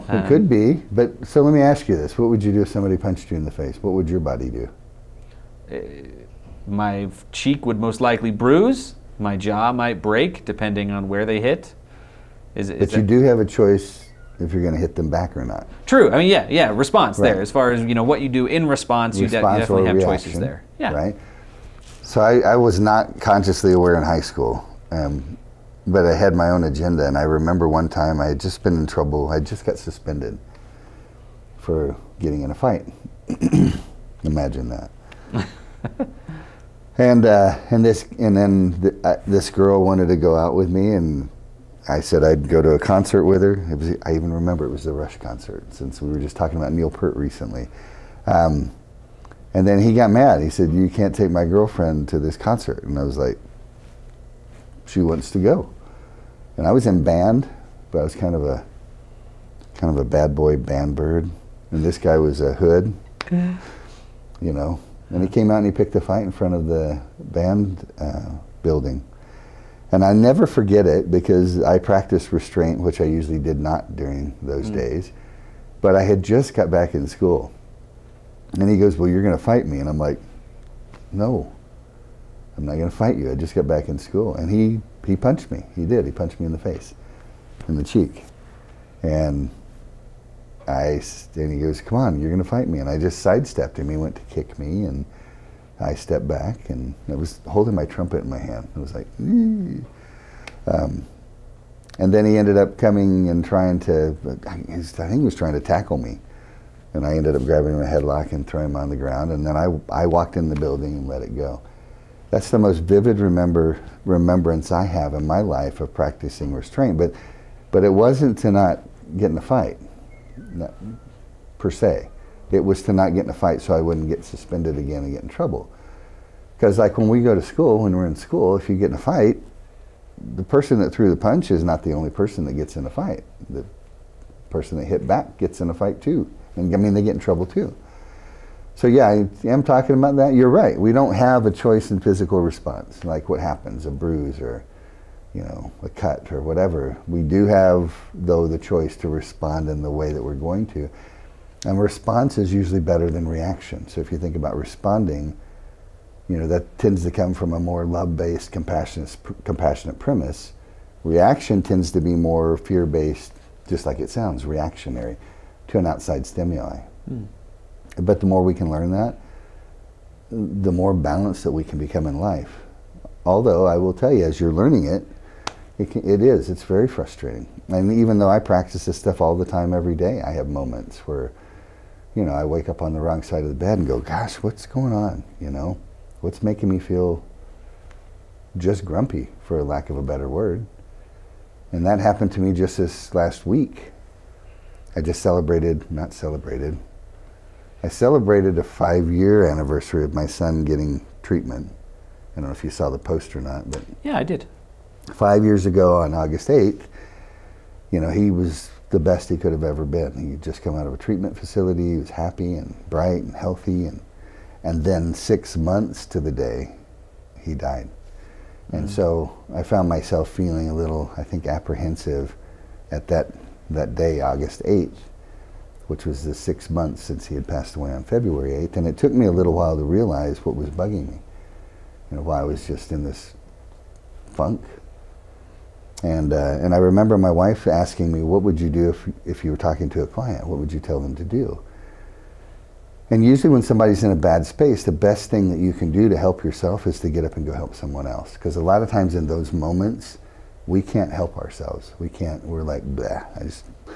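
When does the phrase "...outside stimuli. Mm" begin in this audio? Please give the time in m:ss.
2:45.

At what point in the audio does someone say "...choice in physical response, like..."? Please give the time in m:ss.
2:21.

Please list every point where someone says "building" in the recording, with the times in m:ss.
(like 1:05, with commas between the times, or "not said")
1:08, 1:50.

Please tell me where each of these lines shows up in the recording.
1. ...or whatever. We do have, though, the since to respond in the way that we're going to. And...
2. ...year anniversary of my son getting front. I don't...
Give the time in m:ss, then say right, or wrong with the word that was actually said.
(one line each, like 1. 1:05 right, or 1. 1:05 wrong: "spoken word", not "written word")
1. 2:26 wrong: "choice", not "since"
2. 3:19 wrong: "treatment", not "front".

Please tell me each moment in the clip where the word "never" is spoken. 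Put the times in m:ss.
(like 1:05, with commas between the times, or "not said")
1:10.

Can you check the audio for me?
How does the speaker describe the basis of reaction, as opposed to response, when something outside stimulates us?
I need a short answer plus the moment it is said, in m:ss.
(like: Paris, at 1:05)
fear-based, at 2:42.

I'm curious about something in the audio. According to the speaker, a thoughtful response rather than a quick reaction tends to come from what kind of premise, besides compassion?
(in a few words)
love-based.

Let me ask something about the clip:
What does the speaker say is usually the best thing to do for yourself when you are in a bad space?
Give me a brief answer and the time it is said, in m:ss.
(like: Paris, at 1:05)
go help someone else, at 4:07.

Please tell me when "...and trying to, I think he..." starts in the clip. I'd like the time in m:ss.
1:43.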